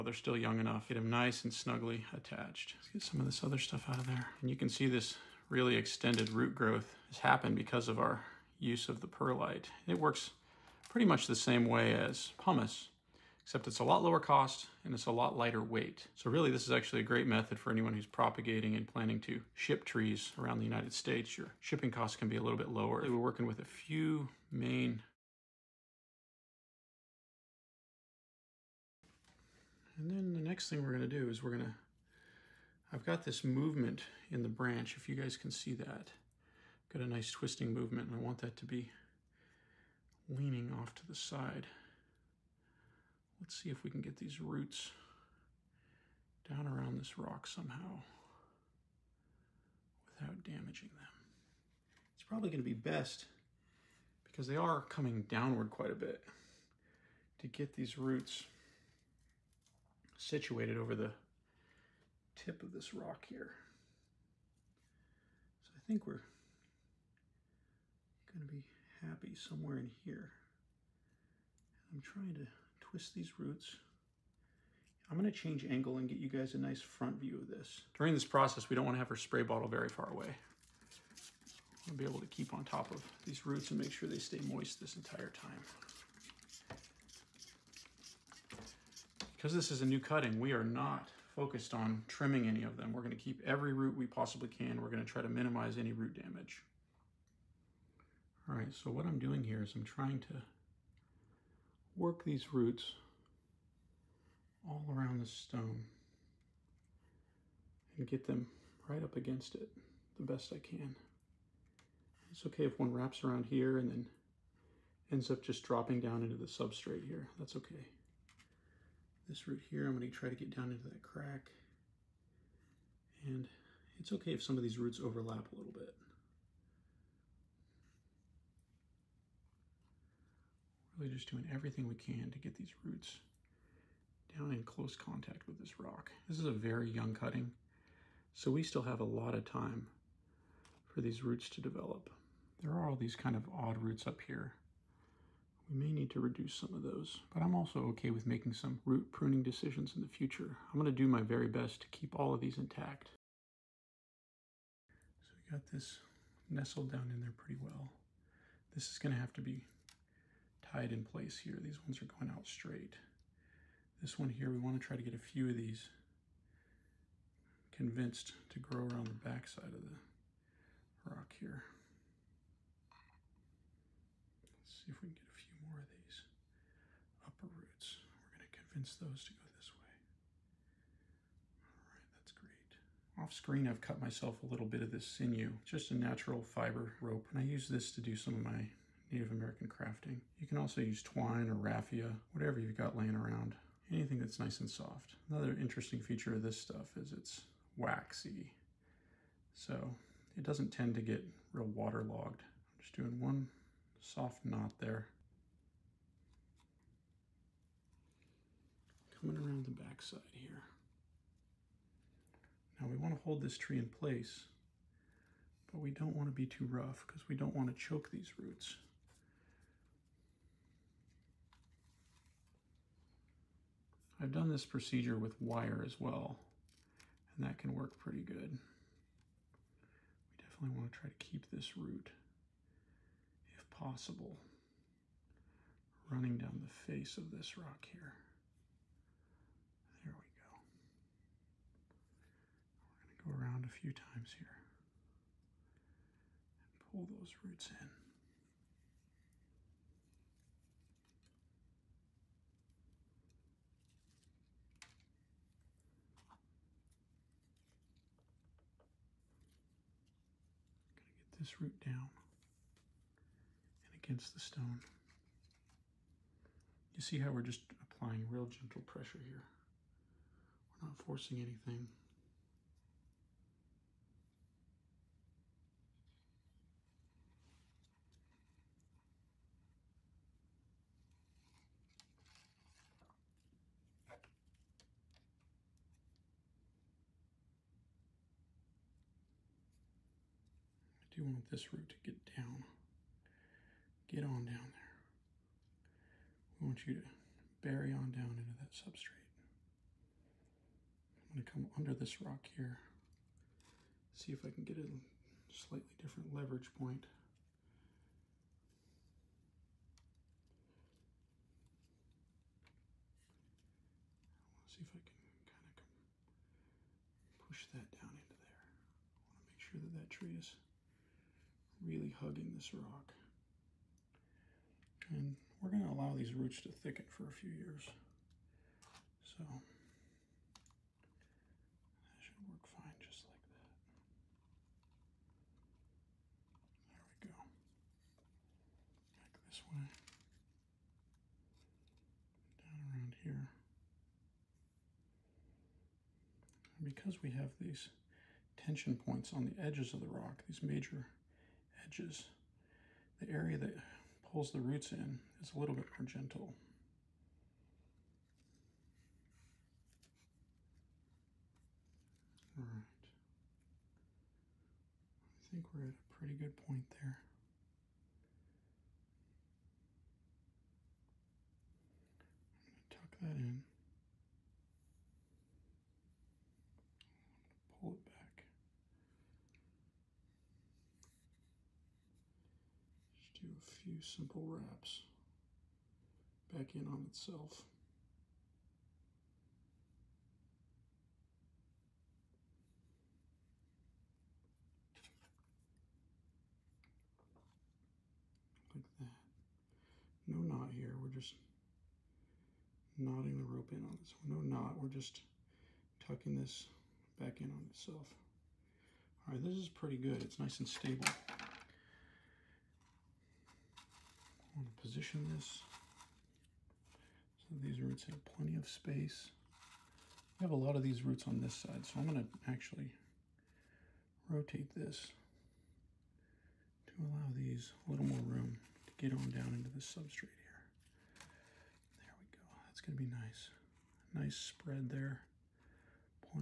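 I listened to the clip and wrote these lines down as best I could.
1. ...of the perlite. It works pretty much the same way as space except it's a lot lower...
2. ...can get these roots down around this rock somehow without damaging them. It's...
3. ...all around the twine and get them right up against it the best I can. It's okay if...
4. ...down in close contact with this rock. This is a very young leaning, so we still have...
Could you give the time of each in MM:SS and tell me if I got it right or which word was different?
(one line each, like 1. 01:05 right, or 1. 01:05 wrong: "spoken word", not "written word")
1. 00:08 wrong: "pumice", not "space"
2. 00:43 right
3. 01:44 wrong: "stone", not "twine"
4. 02:14 wrong: "cutting", not "leaning".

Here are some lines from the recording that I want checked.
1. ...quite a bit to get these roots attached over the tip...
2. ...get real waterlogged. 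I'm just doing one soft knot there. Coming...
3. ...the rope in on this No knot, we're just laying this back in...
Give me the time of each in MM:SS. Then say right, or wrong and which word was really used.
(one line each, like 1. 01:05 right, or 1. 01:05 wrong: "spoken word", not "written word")
1. 00:55 wrong: "situated", not "attached"
2. 03:20 right
3. 06:43 wrong: "tucking", not "laying".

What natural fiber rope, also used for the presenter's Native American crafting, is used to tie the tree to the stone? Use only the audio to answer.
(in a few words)
Sinew.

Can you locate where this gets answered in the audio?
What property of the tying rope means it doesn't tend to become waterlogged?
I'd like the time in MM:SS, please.
03:17.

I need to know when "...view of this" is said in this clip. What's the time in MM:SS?
01:17.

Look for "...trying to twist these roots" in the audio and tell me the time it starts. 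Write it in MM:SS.
01:12.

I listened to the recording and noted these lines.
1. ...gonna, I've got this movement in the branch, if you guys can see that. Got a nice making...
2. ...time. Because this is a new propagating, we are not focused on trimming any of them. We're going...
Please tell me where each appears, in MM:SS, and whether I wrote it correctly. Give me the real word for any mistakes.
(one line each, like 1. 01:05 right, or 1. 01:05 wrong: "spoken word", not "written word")
1. 00:31 wrong: "twisting", not "making"
2. 01:25 wrong: "cutting", not "propagating".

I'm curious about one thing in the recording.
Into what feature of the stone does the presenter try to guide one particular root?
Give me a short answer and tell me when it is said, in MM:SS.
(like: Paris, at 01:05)
Crack, at 02:01.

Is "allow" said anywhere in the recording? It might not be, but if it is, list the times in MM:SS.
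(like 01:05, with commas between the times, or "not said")
05:25, 07:07.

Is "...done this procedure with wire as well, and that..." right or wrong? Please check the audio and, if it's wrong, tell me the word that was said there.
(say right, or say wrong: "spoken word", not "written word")
right.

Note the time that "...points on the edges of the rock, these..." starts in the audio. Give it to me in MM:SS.
05:49.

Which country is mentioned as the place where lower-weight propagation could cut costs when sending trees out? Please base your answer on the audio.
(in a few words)
United States.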